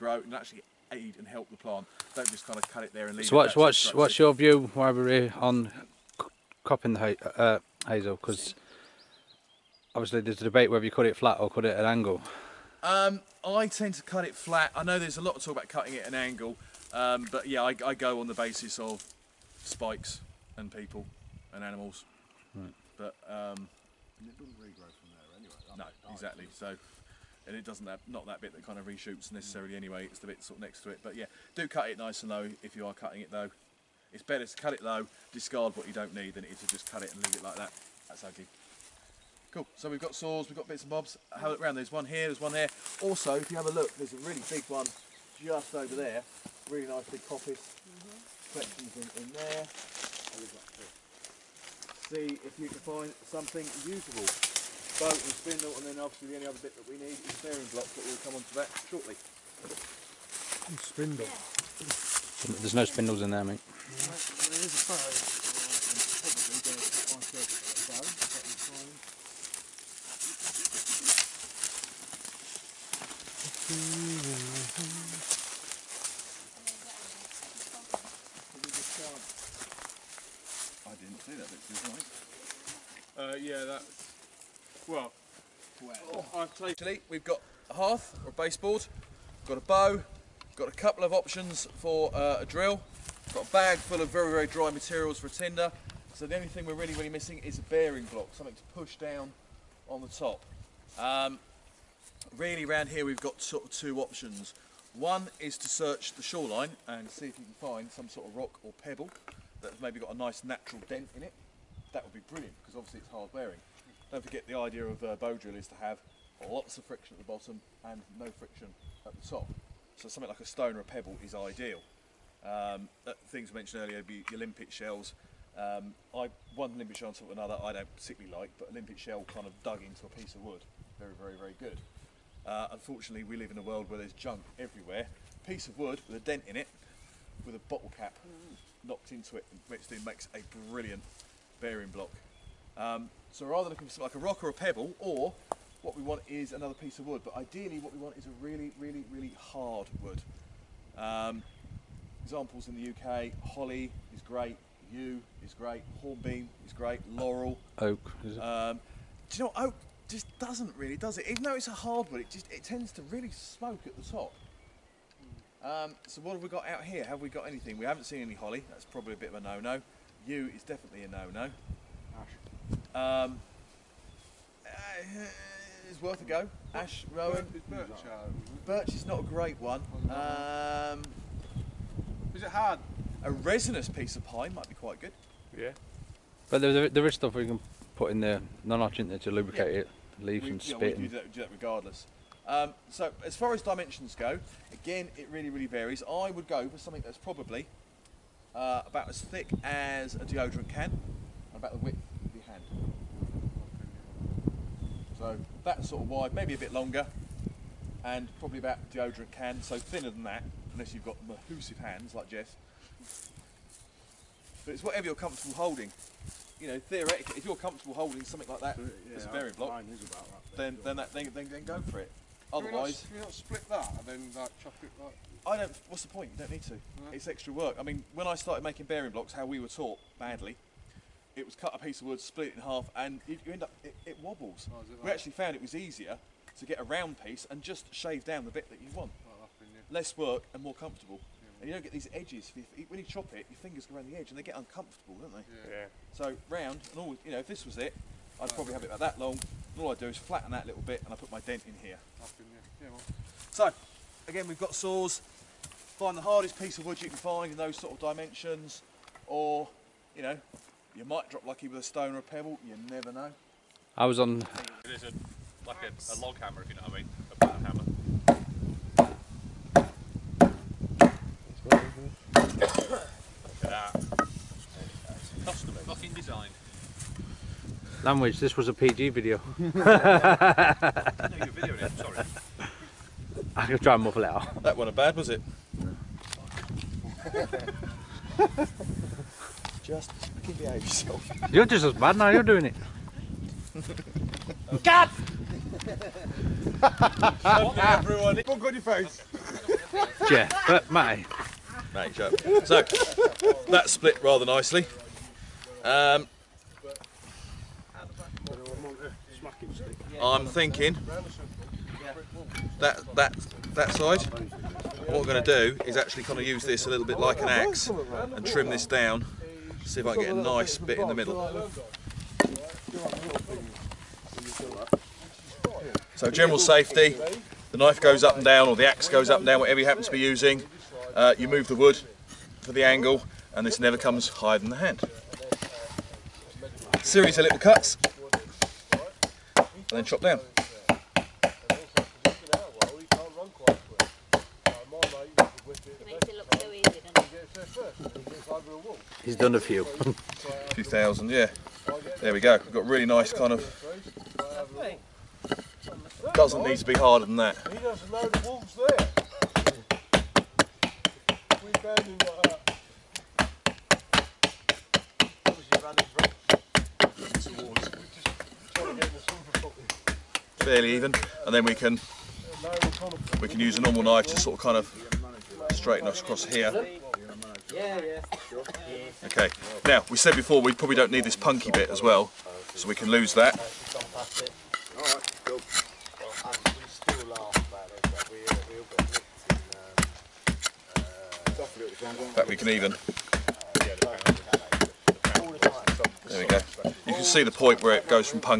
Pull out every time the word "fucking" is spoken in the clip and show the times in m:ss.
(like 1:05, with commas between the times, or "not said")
4:35, 4:50.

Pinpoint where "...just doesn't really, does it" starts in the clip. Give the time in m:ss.
2:40.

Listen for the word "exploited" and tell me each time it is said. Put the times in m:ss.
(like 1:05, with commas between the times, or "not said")
not said.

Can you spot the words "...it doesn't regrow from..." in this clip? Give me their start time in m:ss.
0:24.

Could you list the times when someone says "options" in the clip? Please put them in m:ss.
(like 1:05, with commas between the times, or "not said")
1:31, 1:44.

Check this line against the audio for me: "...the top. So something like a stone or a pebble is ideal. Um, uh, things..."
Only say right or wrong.
right.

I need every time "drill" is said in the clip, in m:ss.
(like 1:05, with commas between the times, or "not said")
1:32, 1:55.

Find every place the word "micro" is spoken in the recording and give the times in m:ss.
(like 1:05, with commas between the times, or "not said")
not said.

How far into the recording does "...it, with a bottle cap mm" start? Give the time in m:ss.
2:16.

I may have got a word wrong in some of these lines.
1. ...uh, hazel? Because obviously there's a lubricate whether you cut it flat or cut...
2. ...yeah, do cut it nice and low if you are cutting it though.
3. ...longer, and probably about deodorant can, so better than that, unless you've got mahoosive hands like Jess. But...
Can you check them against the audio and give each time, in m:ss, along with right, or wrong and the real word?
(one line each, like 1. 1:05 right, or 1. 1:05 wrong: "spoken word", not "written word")
1. 0:07 wrong: "debate", not "lubricate"
2. 0:31 right
3. 3:26 wrong: "thinner", not "better".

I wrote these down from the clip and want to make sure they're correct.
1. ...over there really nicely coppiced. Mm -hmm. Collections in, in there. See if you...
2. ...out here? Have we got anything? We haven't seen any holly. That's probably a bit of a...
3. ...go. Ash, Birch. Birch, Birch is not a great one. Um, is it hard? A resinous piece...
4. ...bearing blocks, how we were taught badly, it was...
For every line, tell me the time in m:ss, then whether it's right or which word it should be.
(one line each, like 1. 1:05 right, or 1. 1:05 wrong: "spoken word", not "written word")
1. 0:45 right
2. 2:46 right
3. 2:56 wrong: "Rowan", not "Birch"
4. 3:48 right.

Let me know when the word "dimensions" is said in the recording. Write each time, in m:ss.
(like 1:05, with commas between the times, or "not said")
3:13, 4:17.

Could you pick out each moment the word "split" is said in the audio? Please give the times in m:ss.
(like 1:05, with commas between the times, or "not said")
3:43, 3:52, 5:03.